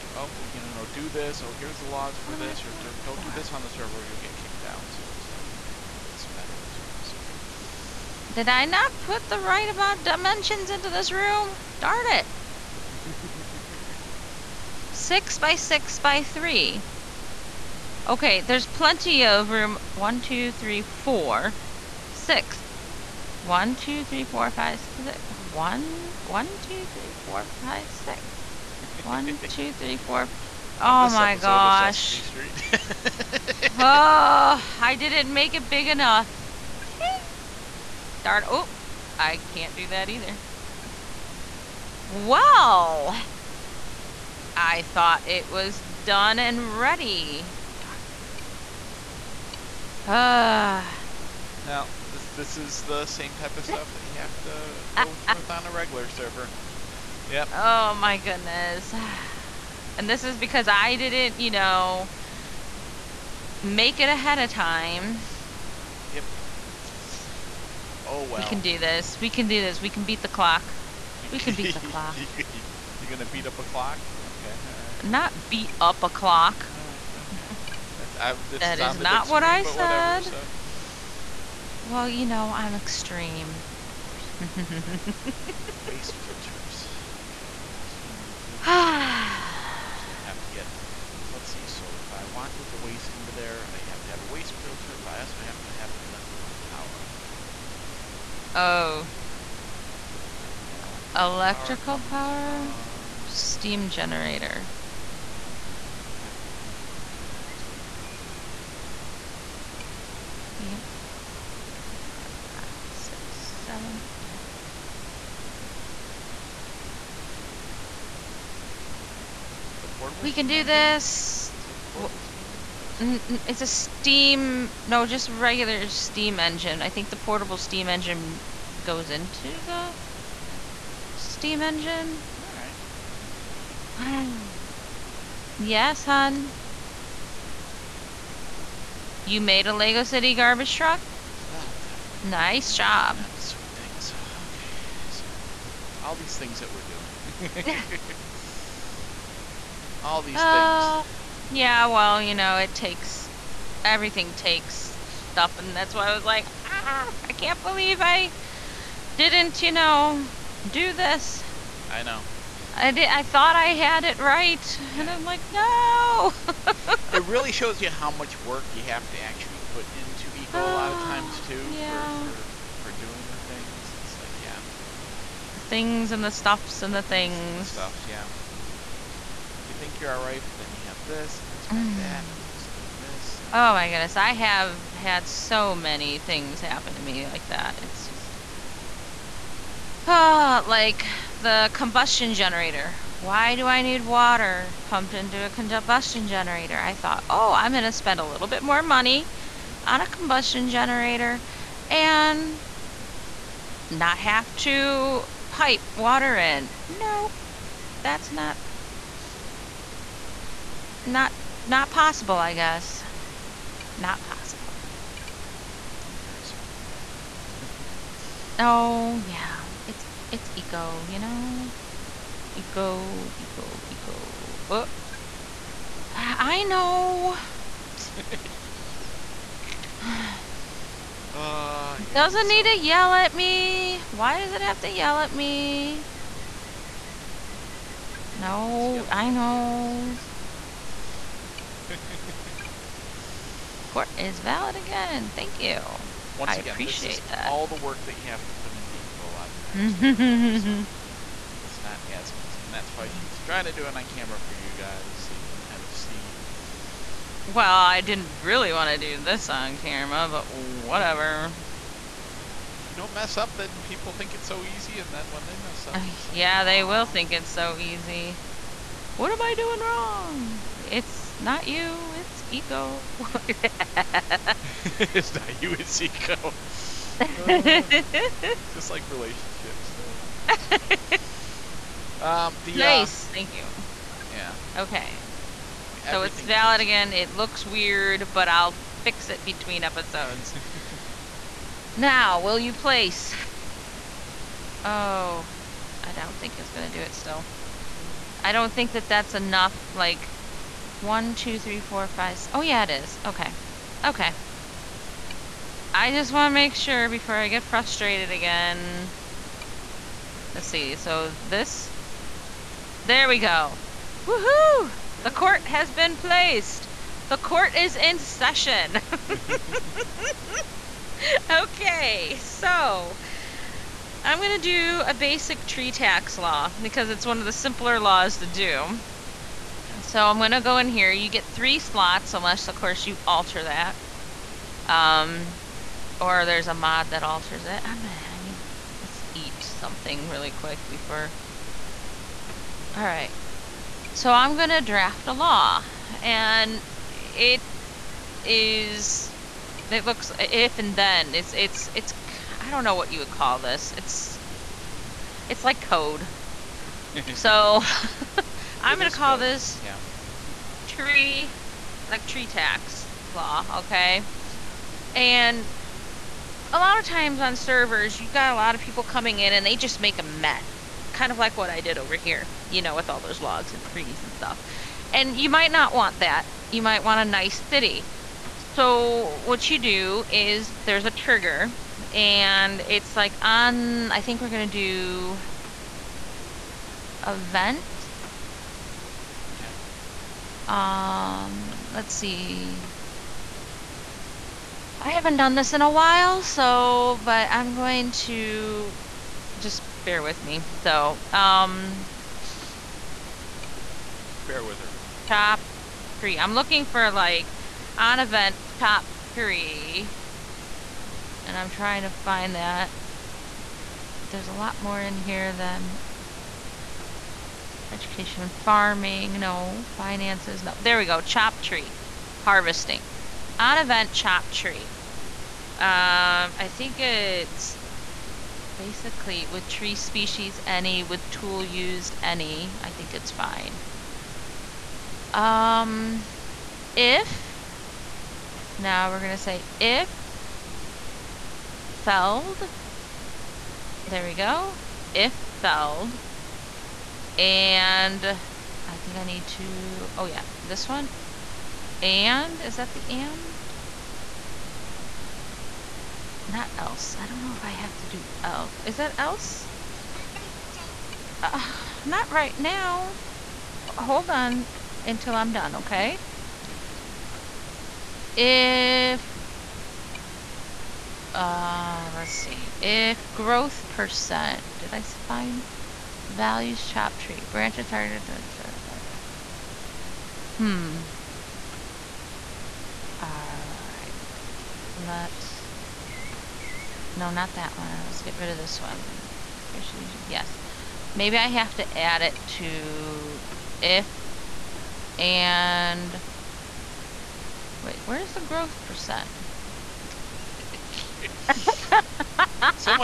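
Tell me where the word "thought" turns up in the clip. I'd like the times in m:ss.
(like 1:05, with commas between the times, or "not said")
0:44, 2:43, 3:16.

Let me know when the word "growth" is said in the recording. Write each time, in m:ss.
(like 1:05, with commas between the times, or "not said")
7:53, 8:18.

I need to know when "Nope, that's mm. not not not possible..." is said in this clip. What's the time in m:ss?
3:26.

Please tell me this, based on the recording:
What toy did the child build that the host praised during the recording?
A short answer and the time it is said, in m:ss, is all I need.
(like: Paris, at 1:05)
Lego City garbage truck, at 2:19.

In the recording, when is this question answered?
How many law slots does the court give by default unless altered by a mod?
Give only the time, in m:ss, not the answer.
5:31.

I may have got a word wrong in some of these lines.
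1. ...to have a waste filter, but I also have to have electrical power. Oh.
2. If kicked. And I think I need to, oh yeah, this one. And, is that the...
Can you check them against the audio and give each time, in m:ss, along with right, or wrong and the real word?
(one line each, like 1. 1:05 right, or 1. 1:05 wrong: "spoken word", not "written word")
1. 1:34 right
2. 7:25 wrong: "felled", not "kicked".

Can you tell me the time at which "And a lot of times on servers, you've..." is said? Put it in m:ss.
6:05.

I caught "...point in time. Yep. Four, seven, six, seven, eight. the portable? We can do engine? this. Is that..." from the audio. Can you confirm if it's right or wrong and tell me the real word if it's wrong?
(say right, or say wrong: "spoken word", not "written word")
wrong: "five", not "seven".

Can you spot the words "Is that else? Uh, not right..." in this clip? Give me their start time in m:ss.
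7:38.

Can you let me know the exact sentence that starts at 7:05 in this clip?
Um, I think it's basically with tree species any, with tool used any, I think it's fine.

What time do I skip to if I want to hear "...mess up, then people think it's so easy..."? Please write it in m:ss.
4:23.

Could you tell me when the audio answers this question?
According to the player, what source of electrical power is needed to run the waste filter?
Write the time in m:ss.
1:43.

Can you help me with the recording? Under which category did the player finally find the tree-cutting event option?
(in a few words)
harvesting.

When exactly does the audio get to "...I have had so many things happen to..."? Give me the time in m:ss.
3:04.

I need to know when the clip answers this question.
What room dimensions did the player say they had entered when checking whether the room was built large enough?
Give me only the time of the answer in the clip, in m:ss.
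0:14.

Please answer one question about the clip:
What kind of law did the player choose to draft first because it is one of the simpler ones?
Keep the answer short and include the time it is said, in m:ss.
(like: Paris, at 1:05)
basic tree tax law, at 5:25.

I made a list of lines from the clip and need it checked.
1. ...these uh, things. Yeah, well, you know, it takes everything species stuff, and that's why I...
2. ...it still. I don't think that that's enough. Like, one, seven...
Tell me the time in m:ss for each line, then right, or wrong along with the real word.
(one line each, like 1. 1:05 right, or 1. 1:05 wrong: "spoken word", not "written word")
1. 2:30 wrong: "takes", not "species"
2. 4:57 wrong: "two", not "seven".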